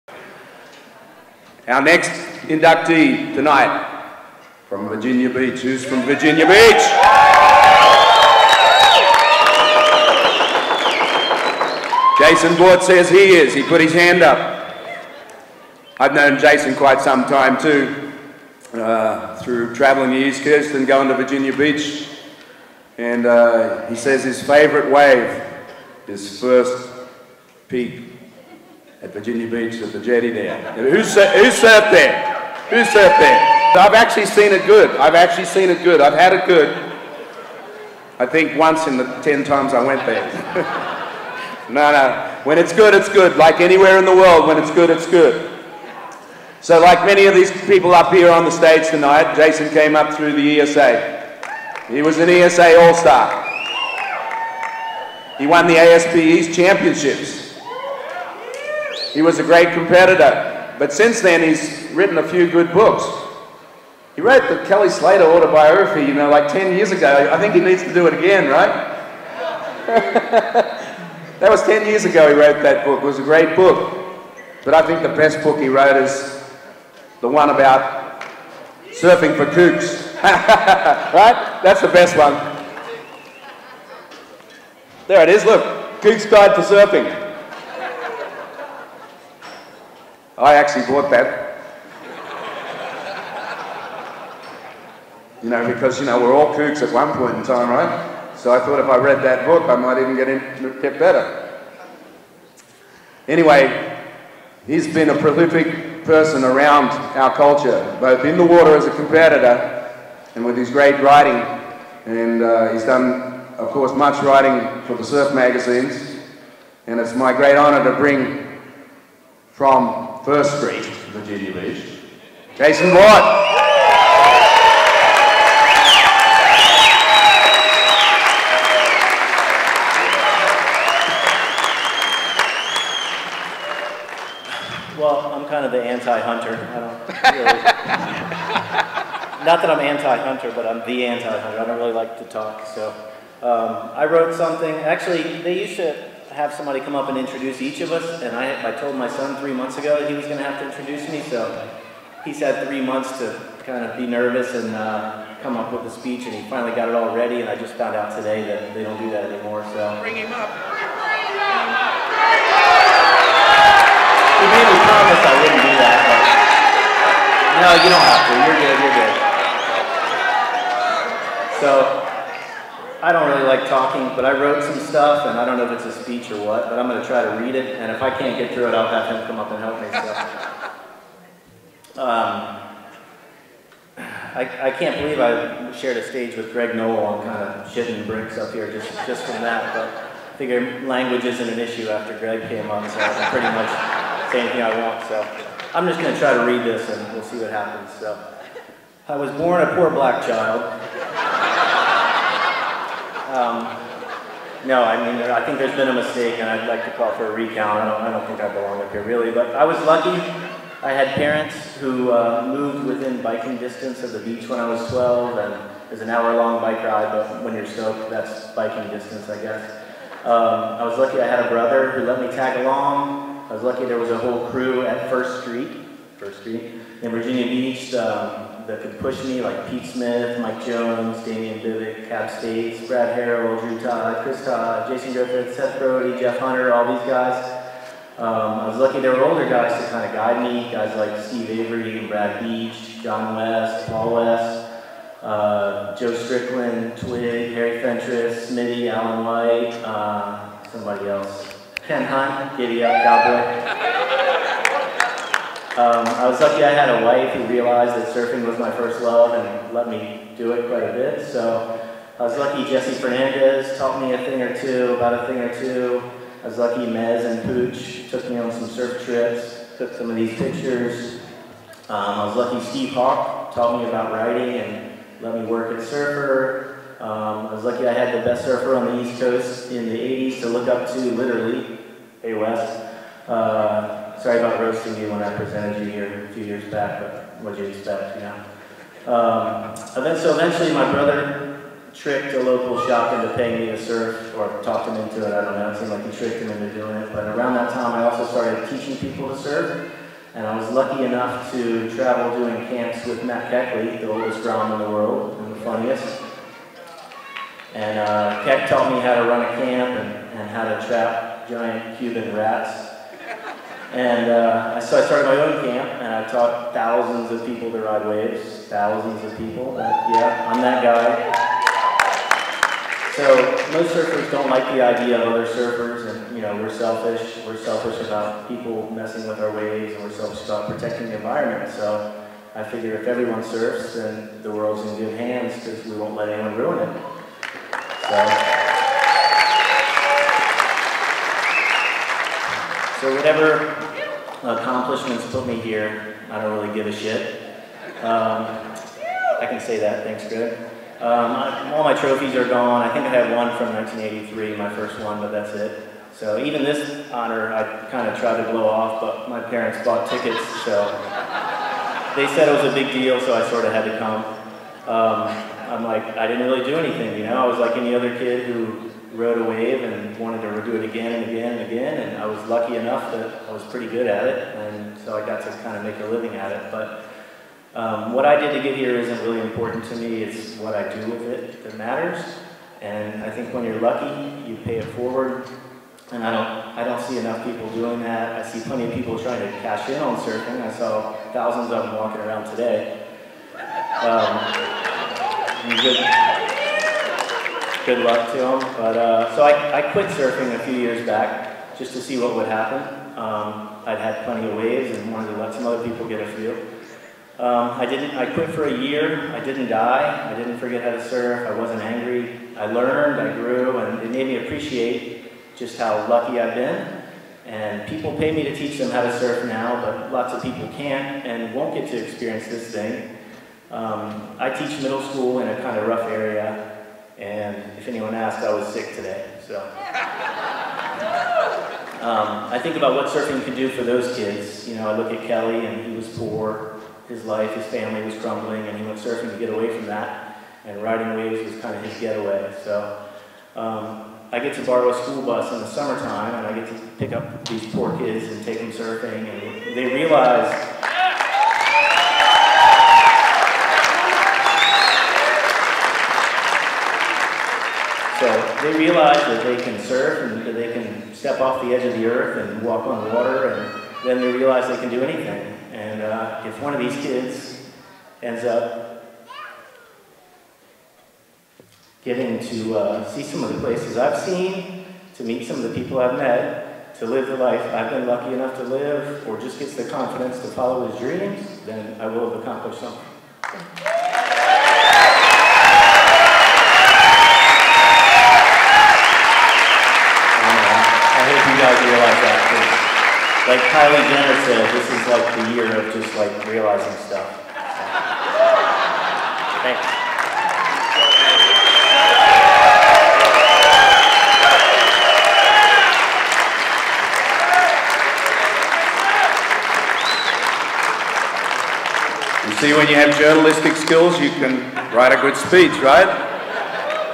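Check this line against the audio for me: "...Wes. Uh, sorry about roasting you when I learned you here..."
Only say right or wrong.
wrong.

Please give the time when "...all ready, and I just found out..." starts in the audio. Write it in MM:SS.
02:36.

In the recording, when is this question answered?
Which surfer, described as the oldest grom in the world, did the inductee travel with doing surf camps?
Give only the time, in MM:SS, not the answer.
05:03.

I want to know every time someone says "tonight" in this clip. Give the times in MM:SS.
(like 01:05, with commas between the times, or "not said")
00:03, 00:48.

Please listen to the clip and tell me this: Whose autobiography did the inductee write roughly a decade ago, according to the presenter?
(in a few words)
Kelly Slater.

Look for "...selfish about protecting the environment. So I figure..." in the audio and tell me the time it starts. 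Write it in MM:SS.
05:30.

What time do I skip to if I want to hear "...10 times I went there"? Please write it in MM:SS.
00:39.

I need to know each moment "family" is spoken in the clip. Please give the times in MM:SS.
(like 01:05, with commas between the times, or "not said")
07:17.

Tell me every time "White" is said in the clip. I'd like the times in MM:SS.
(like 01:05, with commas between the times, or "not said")
02:02, 04:09.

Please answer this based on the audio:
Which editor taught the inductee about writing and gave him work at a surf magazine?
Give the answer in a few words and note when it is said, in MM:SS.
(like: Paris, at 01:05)
Steve Hawk, at 04:32.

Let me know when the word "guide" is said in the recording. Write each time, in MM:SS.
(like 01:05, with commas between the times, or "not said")
01:26, 04:00.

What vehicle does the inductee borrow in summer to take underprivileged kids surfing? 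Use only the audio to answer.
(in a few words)
A school bus.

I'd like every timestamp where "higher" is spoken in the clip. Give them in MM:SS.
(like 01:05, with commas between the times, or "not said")
not said.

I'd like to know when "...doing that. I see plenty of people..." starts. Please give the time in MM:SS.
06:27.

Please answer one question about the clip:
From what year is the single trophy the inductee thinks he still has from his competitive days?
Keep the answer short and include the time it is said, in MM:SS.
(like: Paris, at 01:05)
1983, at 05:53.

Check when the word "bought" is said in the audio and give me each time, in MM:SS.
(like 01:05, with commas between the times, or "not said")
01:30, 05:59.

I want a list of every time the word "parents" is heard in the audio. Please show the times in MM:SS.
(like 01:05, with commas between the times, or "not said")
03:31, 05:59.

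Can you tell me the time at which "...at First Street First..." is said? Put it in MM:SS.
03:44.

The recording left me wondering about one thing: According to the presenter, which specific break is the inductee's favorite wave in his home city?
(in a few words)
First peak.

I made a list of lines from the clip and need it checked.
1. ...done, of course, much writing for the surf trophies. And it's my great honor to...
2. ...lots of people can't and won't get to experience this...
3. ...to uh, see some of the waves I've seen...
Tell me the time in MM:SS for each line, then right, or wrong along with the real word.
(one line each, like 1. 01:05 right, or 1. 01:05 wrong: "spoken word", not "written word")
1. 01:52 wrong: "magazines", not "trophies"
2. 07:00 right
3. 07:52 wrong: "places", not "waves".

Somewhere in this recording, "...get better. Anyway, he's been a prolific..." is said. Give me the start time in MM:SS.
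01:40.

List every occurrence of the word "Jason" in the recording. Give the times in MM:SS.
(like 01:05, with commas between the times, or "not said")
00:12, 00:16, 00:49, 02:02, 03:54.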